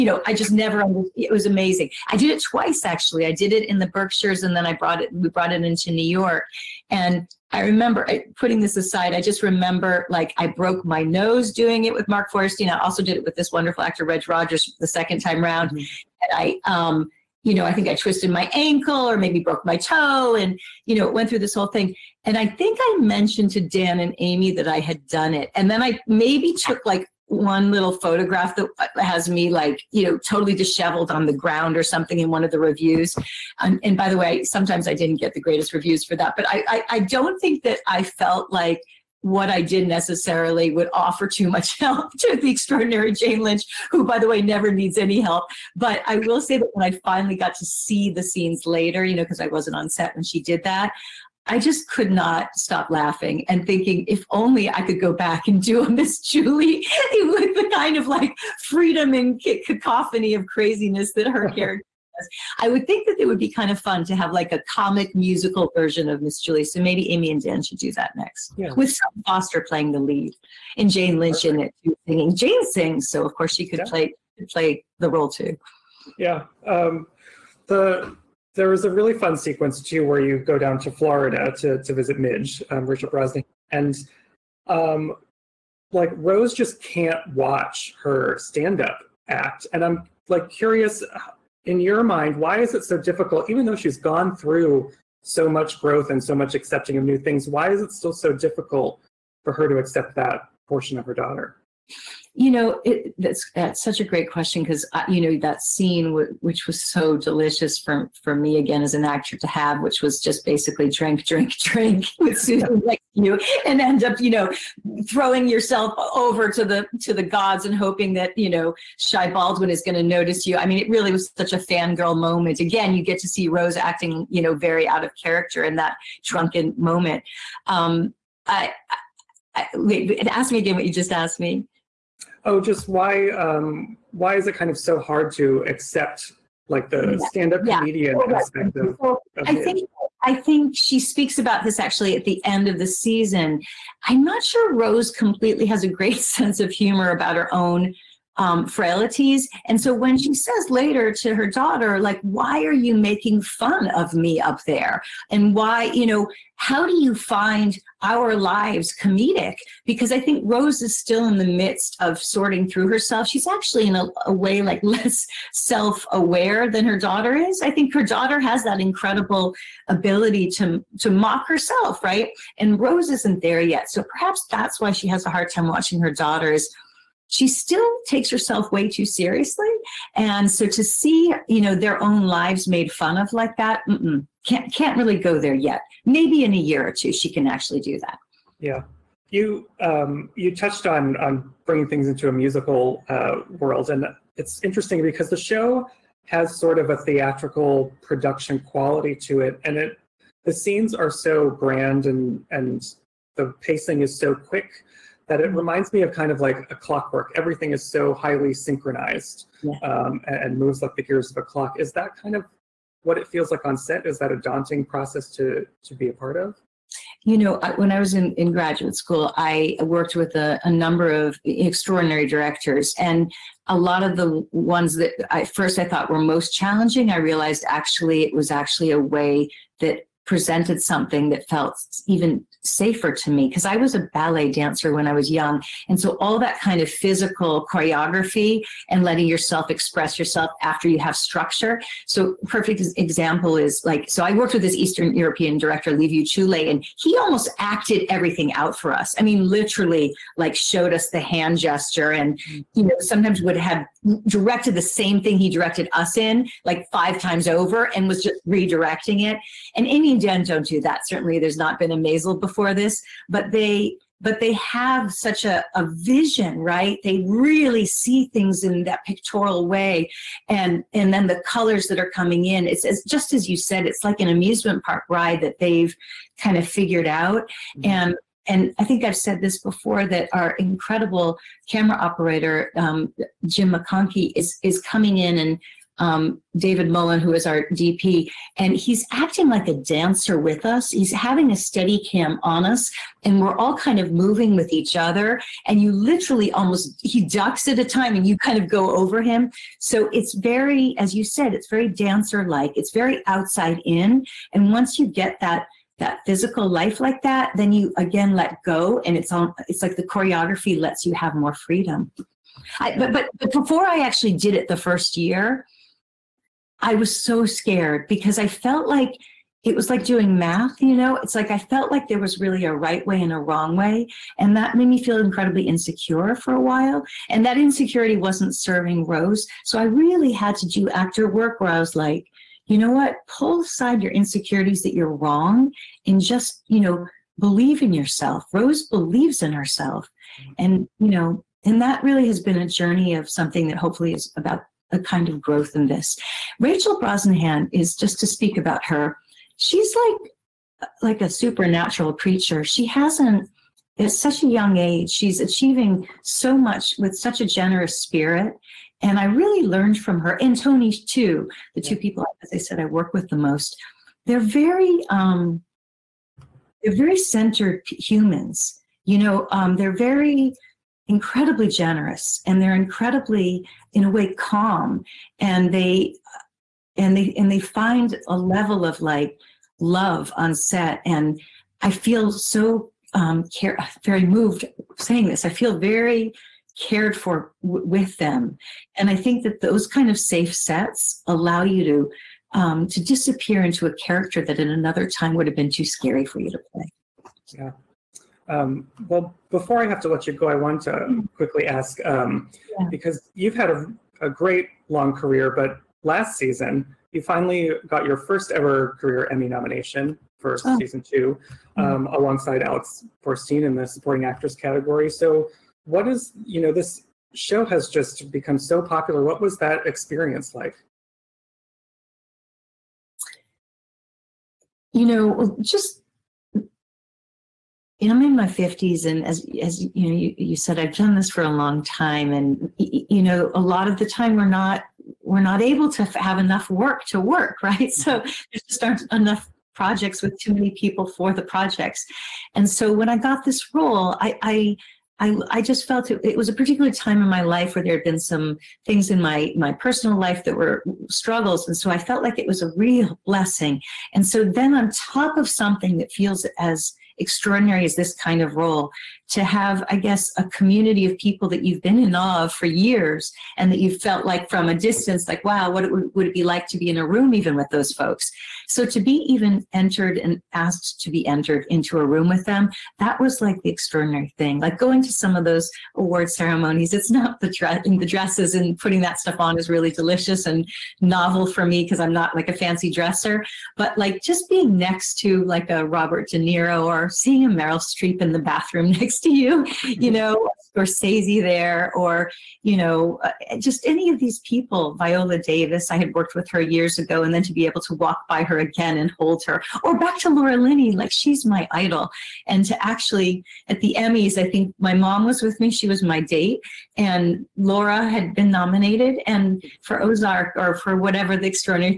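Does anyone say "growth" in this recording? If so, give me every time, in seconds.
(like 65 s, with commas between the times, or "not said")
95 s, 345 s.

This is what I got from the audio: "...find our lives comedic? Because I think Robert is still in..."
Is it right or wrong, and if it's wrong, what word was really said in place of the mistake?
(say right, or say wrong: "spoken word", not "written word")
wrong: "Rose", not "Robert".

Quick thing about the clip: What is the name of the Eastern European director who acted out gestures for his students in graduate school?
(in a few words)
Liviu Ciulei.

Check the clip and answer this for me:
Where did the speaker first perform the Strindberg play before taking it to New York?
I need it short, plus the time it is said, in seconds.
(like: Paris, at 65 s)
The Berkshires, at 3 s.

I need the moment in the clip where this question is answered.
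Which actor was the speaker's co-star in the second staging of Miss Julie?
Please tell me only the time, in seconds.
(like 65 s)
14 s.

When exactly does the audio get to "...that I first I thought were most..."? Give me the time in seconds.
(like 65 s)
224 s.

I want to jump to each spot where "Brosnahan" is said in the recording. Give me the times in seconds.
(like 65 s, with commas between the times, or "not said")
83 s, 347 s.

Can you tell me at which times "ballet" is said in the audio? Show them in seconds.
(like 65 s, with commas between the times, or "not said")
234 s.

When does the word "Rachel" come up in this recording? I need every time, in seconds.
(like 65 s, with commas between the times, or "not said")
82 s, 346 s.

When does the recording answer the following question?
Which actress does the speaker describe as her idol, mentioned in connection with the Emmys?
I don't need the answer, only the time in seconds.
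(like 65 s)
500 s.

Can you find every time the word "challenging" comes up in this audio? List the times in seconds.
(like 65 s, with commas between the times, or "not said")
226 s.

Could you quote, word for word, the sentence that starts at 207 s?
Everything is so highly synchronized yeah.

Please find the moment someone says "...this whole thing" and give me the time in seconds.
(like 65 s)
21 s.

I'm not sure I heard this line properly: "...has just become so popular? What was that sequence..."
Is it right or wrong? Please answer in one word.
wrong.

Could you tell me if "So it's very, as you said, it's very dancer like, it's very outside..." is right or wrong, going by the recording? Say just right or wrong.
right.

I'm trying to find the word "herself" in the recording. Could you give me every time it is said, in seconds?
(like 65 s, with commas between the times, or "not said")
162 s, 171 s, 178 s, 339 s.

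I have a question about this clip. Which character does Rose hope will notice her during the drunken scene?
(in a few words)
Shy Baldwin.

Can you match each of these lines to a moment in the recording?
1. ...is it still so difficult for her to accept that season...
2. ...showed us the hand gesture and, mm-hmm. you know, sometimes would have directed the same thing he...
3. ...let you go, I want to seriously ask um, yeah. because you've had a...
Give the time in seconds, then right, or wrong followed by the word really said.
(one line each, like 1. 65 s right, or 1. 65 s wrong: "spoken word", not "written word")
1. 97 s wrong: "portion", not "season"
2. 250 s right
3. 400 s wrong: "quickly", not "seriously".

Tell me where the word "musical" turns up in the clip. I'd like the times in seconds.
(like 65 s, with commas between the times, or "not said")
65 s, 192 s.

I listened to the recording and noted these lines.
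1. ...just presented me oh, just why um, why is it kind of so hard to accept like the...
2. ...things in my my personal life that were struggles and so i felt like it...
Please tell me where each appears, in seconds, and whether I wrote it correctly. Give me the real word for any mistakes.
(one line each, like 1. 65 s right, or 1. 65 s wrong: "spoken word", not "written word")
1. 130 s wrong: "asked", not "presented"
2. 448 s right.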